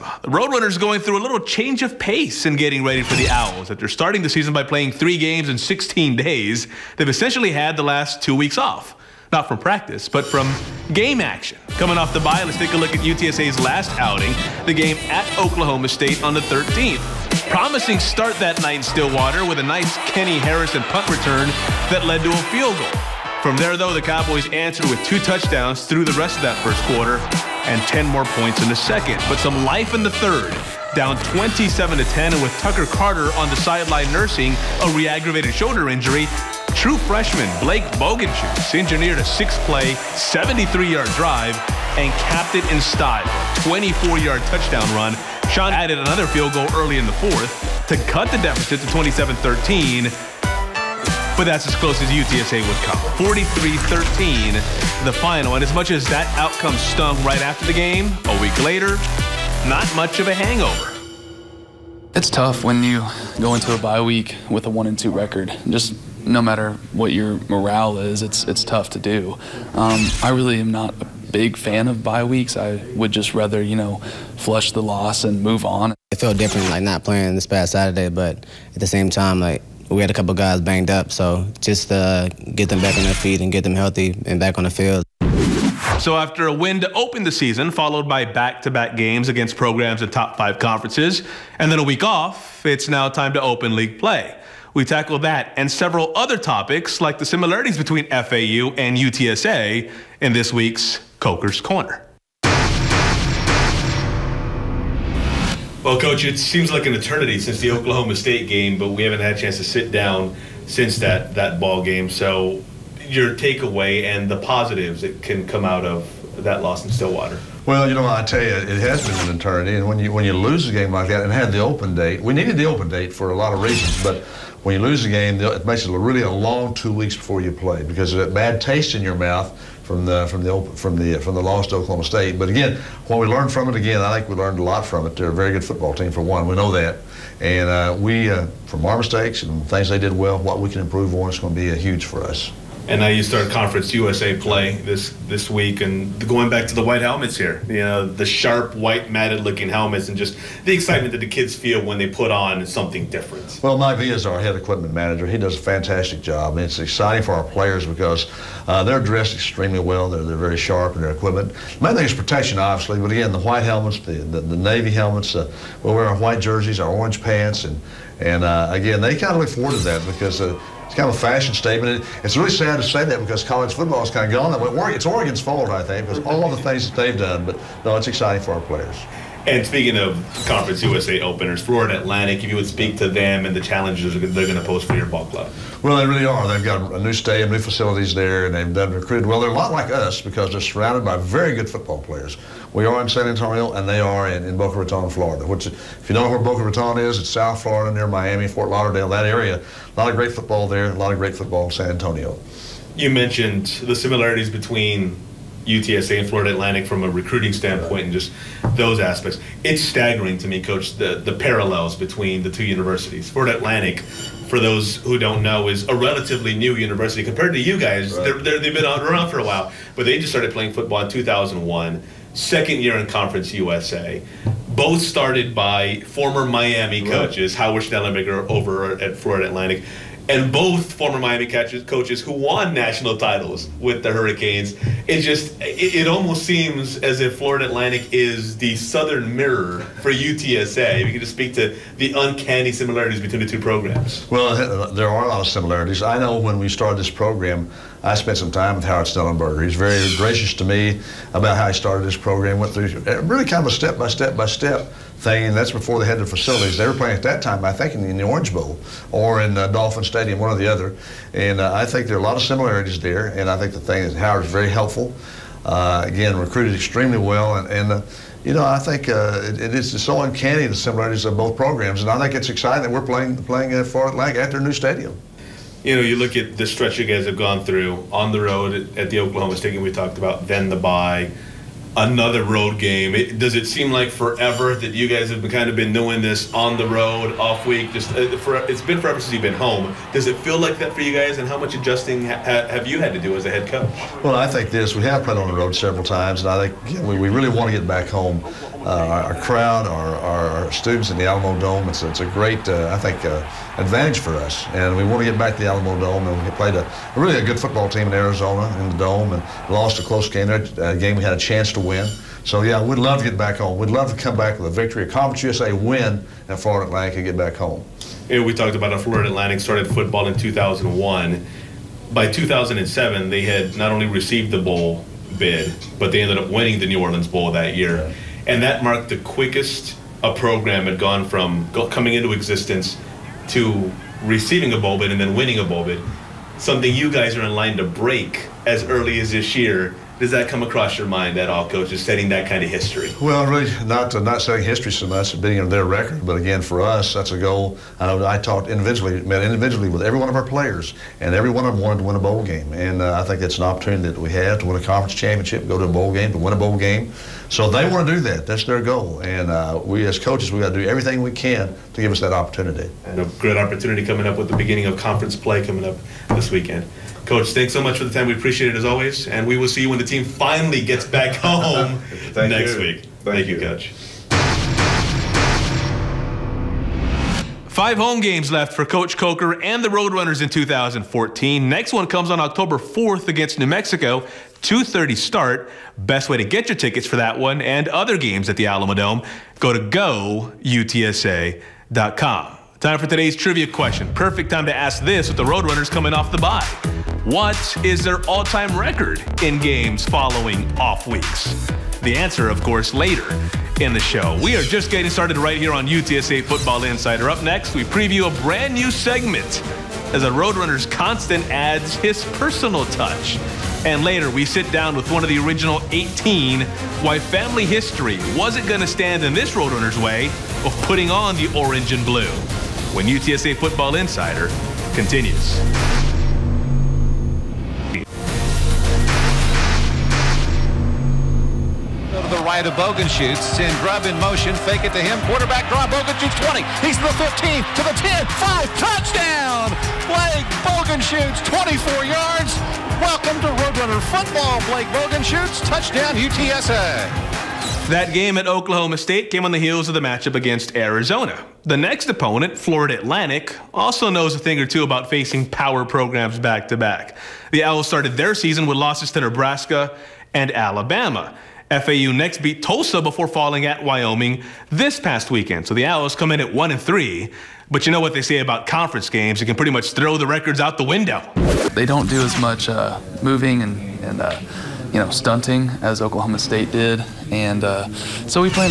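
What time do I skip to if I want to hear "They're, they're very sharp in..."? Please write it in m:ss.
2:40.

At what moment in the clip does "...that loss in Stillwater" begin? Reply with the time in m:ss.
1:56.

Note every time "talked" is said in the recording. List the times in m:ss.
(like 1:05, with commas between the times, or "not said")
4:39, 5:18, 5:48.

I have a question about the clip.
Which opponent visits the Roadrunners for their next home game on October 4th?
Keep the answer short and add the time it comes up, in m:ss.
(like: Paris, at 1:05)
New Mexico, at 6:23.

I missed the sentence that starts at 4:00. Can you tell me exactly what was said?
If you could just speak to the uncanny similarities between the two programs.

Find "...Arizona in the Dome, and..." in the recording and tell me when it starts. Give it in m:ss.
5:08.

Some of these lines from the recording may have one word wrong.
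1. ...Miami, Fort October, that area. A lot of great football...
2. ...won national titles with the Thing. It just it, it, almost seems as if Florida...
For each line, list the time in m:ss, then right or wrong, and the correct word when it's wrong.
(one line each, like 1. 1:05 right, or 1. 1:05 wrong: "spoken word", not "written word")
1. 3:18 wrong: "Lauderdale", not "October"
2. 3:52 wrong: "Hurricanes", not "Thing".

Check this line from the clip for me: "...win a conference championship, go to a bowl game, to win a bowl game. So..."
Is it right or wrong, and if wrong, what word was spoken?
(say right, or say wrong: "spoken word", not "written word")
right.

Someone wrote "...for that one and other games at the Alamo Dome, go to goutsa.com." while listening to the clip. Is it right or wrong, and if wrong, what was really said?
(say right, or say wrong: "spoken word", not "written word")
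right.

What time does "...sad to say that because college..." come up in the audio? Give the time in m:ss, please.
2:52.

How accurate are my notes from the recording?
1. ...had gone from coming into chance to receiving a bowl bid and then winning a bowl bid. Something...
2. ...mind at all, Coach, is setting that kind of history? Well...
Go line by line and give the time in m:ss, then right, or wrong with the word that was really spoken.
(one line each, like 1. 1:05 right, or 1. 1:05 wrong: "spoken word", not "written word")
1. 5:30 wrong: "existence", not "chance"
2. 5:41 right.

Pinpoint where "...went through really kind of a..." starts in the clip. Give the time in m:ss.
4:12.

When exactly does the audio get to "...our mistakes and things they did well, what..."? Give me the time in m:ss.
2:18.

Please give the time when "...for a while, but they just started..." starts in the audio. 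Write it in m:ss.
3:39.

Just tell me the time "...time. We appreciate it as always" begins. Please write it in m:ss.
6:08.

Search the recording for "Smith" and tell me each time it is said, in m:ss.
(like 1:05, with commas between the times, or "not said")
not said.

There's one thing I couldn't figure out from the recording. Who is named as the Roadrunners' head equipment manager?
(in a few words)
Mike V.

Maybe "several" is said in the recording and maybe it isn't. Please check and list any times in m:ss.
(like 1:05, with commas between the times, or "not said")
1:35, 4:55.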